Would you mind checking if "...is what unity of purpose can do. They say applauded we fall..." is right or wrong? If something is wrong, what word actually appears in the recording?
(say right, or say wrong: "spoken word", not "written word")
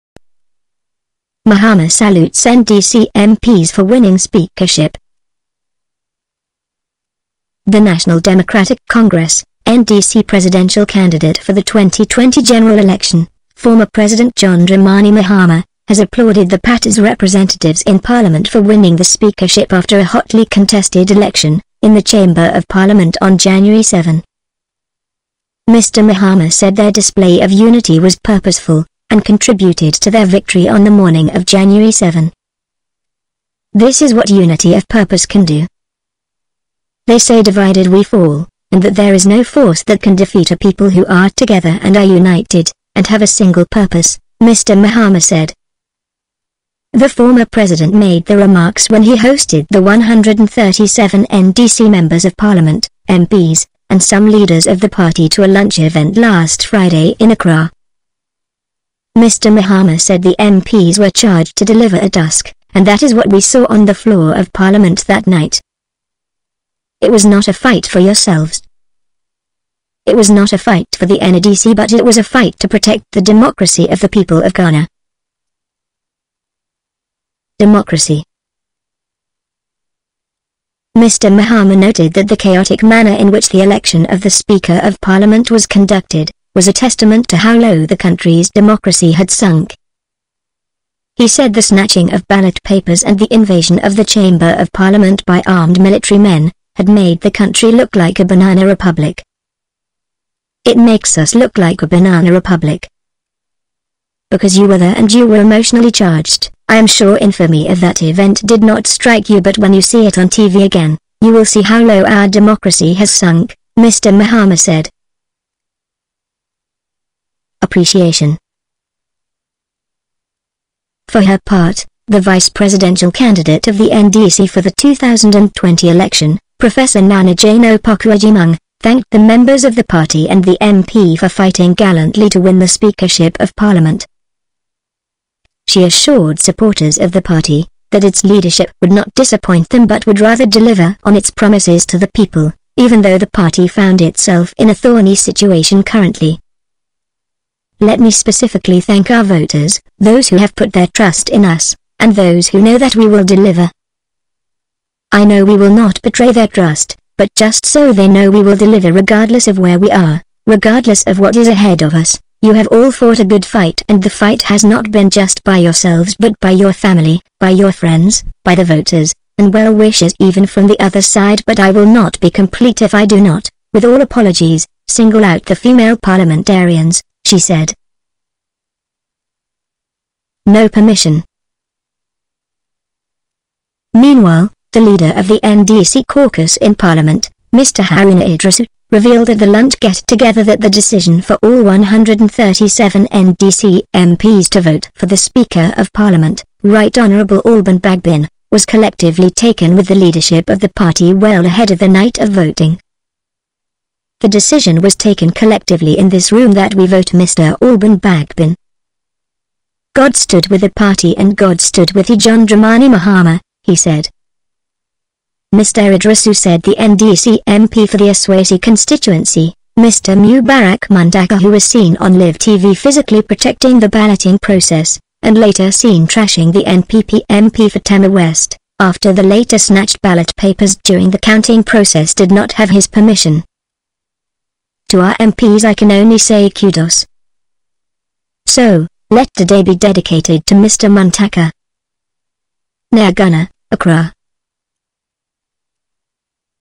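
wrong: "divided", not "applauded".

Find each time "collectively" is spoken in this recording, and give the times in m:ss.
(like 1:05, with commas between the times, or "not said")
3:18, 3:25.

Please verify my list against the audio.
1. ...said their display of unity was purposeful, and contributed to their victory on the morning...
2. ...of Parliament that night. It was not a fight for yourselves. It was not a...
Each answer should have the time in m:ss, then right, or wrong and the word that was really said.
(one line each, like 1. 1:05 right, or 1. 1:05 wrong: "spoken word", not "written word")
1. 0:26 right
2. 1:04 right.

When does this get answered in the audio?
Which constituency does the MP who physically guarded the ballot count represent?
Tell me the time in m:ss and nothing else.
3:38.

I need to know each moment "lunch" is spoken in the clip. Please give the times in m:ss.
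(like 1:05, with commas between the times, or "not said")
0:55, 3:09.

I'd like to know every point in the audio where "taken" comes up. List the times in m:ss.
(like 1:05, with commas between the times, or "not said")
3:19, 3:24.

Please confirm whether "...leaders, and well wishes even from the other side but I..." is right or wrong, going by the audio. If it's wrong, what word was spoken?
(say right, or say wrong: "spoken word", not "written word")
wrong: "voters", not "leaders".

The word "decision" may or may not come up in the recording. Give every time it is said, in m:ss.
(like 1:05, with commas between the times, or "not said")
3:10, 3:24.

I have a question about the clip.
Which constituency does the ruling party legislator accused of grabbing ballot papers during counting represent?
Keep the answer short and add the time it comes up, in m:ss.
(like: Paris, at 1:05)
Tema West, at 3:47.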